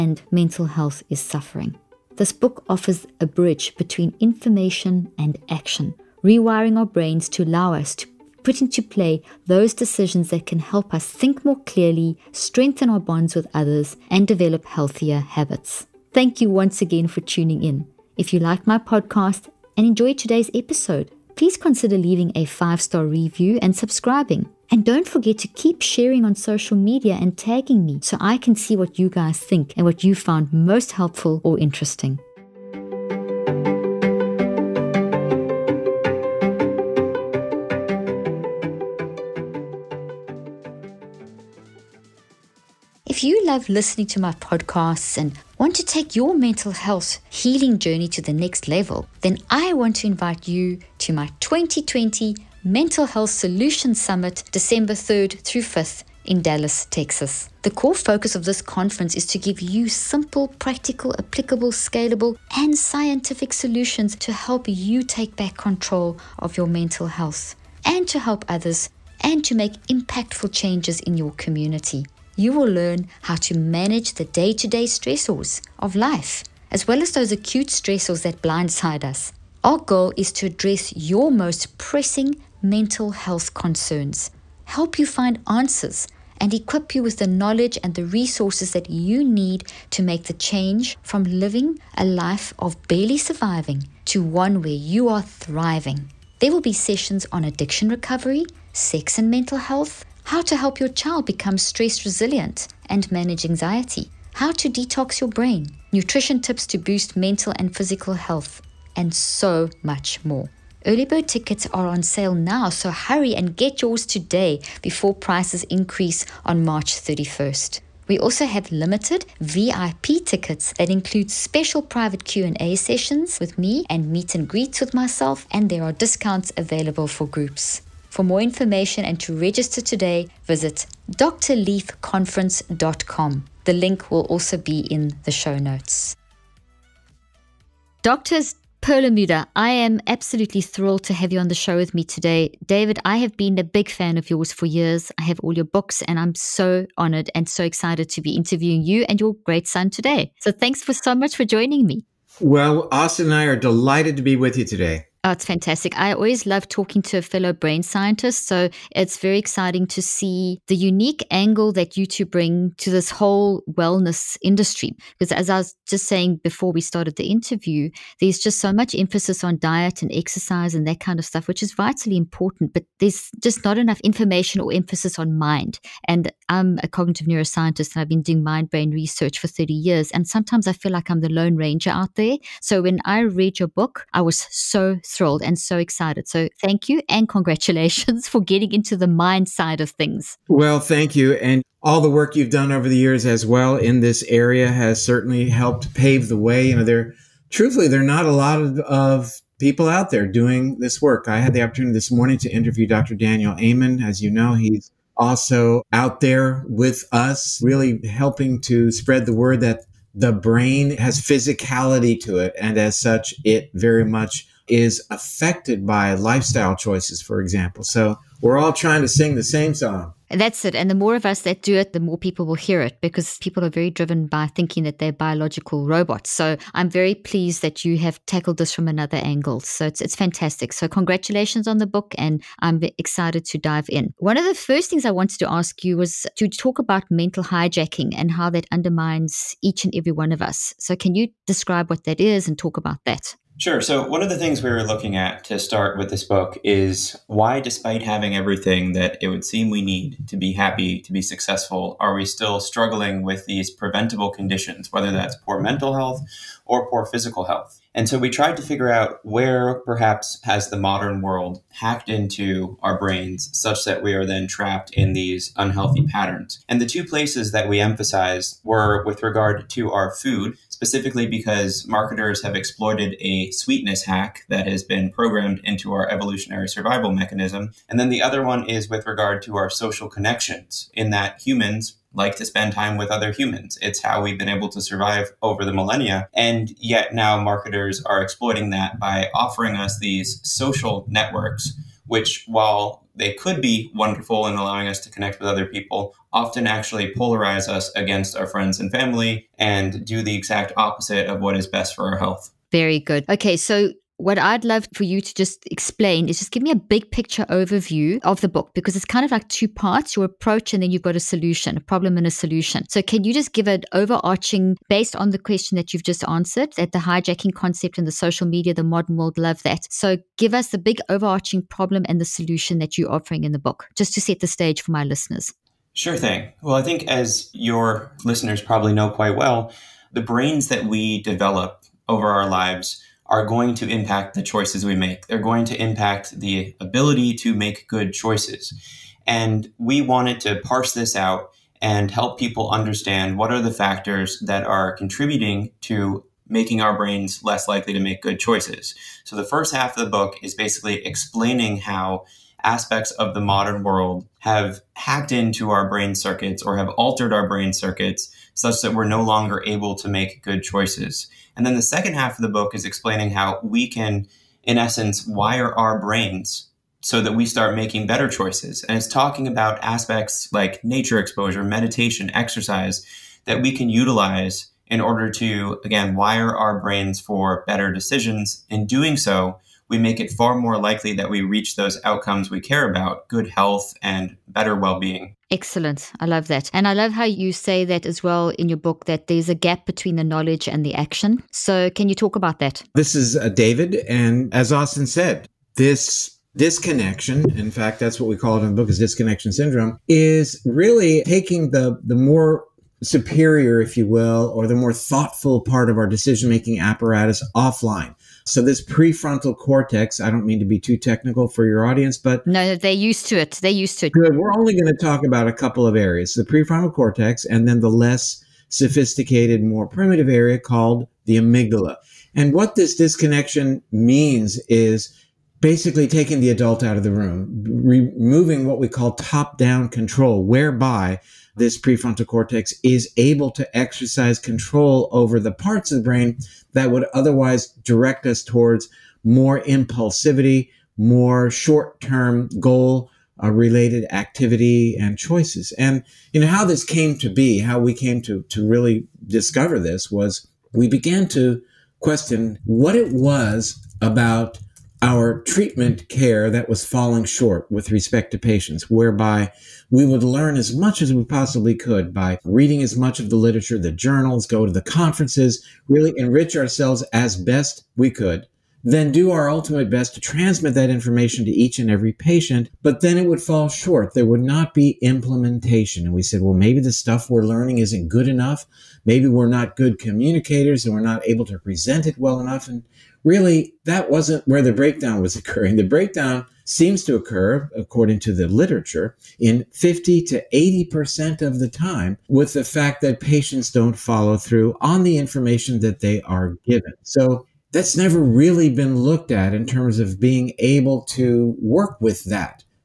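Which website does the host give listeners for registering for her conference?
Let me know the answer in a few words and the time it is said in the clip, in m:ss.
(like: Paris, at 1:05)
drleafconference.com, at 2:11.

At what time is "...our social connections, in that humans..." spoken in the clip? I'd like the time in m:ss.
4:39.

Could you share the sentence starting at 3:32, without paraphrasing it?
And as such, it very much is affected by lifestyle choices, for example.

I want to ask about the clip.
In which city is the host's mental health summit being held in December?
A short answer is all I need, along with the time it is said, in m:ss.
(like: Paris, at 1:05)
Dallas, Texas, at 0:56.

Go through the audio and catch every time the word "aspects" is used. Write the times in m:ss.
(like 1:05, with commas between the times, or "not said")
5:52, 6:09.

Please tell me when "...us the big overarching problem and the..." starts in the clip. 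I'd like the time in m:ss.
5:20.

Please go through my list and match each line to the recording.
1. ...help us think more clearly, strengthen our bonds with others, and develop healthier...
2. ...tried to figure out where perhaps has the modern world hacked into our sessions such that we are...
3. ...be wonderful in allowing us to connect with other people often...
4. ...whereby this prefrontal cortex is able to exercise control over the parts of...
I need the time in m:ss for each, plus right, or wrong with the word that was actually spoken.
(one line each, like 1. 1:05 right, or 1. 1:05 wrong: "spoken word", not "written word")
1. 0:10 right
2. 4:18 wrong: "brains", not "sessions"
3. 4:53 right
4. 7:10 right.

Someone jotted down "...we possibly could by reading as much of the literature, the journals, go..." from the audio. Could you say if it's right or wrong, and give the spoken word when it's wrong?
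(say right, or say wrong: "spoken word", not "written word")
right.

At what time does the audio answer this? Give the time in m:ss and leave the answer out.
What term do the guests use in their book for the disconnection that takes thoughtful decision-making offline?
6:38.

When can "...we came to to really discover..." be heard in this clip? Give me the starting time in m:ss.
7:27.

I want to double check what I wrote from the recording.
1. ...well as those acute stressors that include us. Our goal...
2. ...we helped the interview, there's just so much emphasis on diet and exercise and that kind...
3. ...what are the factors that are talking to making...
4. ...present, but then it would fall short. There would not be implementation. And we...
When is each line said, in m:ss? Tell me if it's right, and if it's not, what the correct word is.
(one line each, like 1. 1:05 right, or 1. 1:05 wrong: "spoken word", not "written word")
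1. 1:16 wrong: "blindside", not "include"
2. 2:46 wrong: "started", not "helped"
3. 5:43 wrong: "contributing", not "talking"
4. 7:52 wrong: "patient", not "present".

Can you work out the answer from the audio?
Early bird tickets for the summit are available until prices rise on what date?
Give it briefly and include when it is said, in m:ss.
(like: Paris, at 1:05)
March 31st, at 1:56.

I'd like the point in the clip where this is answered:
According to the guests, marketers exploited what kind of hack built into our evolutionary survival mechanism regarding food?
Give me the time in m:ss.
4:33.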